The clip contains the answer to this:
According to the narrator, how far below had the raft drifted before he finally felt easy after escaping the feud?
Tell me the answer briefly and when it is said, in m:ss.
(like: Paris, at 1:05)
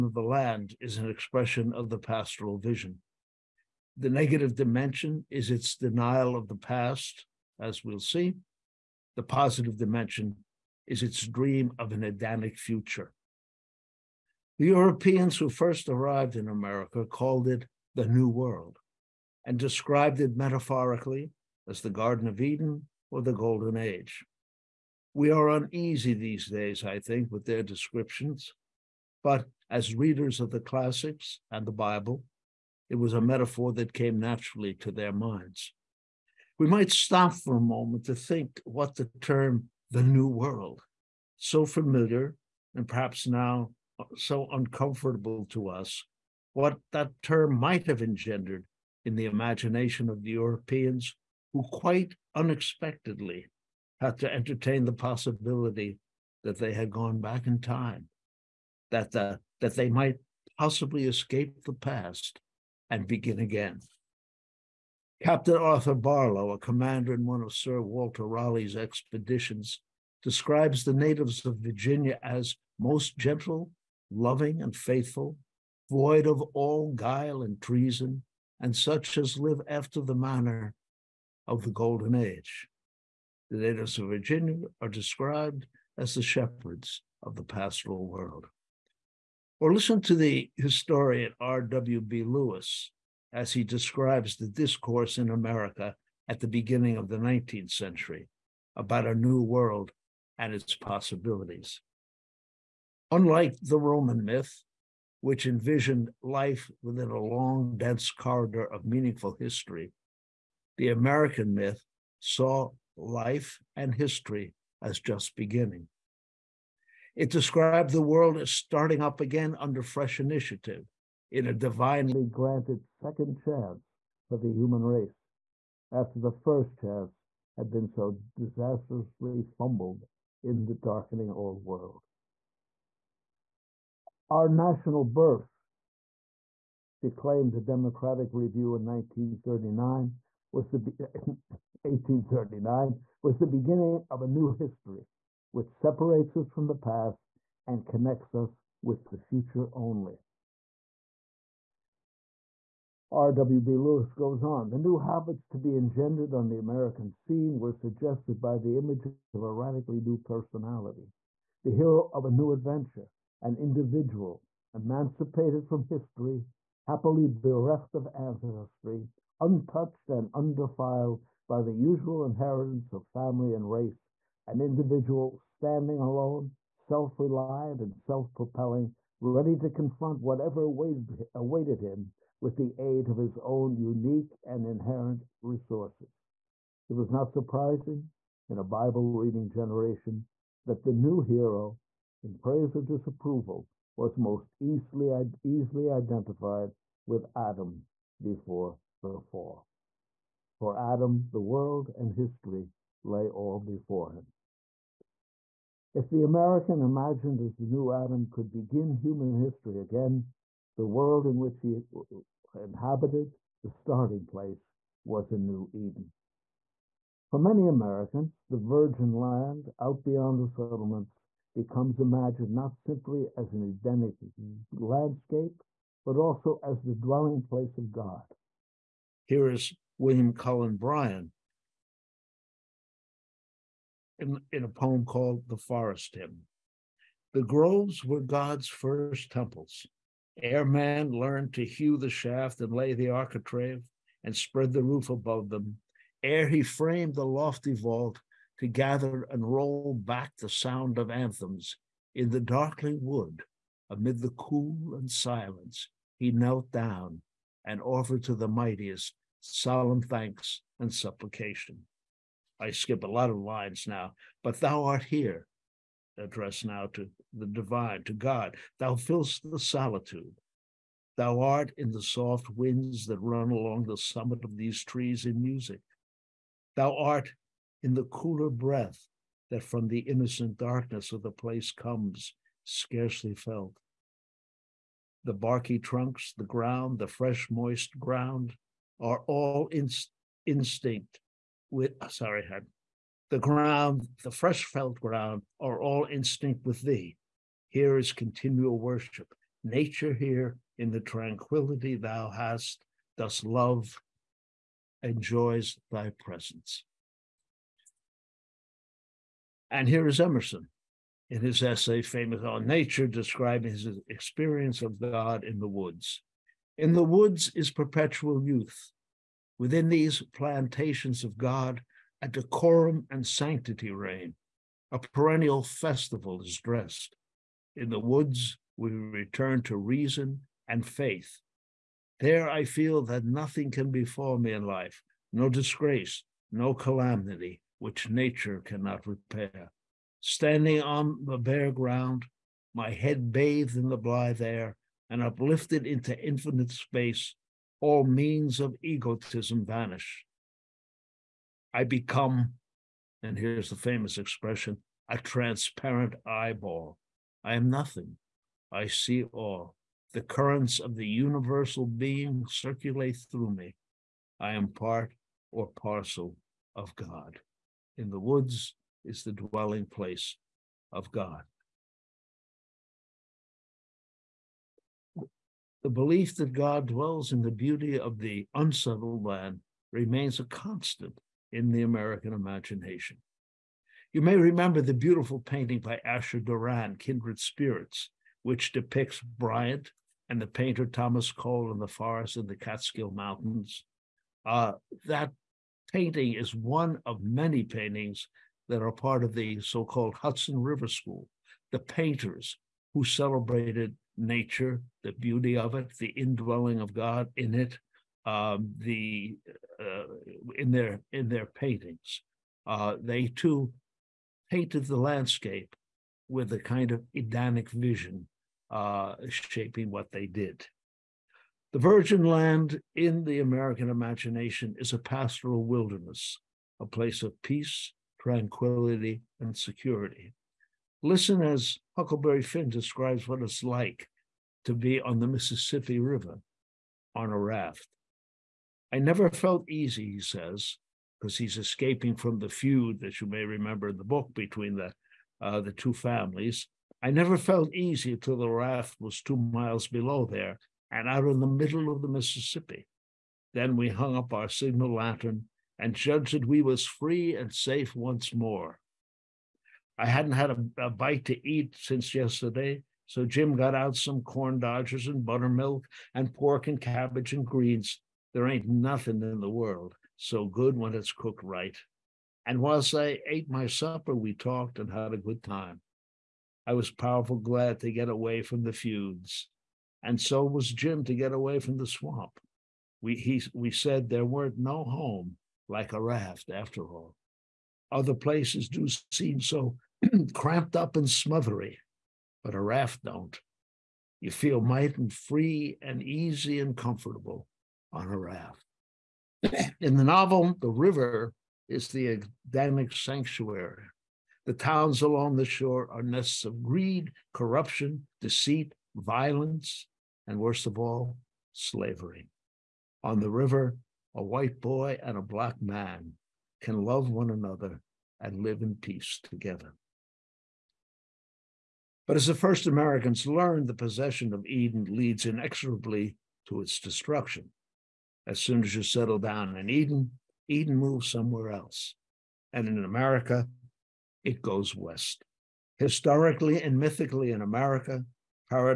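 2 miles, at 7:29.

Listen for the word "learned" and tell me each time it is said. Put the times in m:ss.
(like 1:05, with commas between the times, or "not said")
4:01, 8:43.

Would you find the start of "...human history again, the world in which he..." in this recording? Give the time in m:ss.
3:28.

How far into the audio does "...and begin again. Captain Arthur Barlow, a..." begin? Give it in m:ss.
1:02.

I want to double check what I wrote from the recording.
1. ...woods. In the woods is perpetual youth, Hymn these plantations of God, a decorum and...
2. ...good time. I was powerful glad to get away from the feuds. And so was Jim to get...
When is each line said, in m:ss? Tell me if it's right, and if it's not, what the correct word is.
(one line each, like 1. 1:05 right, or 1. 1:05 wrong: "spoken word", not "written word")
1. 5:15 wrong: "Within", not "Hymn"
2. 7:55 right.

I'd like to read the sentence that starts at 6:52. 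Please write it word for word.
Uh, they too painted the landscape with a kind of Edenic vision, uh, shaping what they did.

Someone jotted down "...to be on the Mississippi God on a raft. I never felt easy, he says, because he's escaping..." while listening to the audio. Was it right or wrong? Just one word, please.
wrong.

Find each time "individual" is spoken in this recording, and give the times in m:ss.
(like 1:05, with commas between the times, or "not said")
2:43, 2:54.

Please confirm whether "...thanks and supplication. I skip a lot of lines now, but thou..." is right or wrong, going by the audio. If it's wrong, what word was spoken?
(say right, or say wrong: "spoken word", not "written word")
right.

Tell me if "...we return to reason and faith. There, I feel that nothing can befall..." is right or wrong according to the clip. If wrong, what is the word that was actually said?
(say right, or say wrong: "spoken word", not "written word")
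right.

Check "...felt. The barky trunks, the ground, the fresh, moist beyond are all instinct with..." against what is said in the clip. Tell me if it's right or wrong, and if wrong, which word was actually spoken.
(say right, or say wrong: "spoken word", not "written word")
wrong: "ground", not "beyond".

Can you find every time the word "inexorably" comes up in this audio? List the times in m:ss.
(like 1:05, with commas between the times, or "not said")
8:45.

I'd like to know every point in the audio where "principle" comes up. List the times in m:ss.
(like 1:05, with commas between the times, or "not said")
not said.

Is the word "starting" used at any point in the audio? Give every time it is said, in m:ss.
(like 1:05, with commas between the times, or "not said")
1:58, 3:33.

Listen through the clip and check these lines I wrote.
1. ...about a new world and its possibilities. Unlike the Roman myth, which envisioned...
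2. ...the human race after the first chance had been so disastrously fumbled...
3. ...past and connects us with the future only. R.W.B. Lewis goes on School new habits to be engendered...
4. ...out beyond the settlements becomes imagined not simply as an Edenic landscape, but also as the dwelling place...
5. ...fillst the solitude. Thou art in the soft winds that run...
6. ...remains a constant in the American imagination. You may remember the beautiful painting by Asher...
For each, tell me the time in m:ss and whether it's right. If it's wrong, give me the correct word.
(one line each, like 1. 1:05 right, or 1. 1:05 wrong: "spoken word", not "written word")
1. 1:38 right
2. 2:04 right
3. 2:26 wrong: "The", not "School"
4. 3:39 right
5. 4:28 right
6. 6:19 right.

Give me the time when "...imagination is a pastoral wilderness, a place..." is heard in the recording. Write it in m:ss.
7:03.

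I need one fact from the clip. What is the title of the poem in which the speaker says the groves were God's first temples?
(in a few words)
The Forest Hymn.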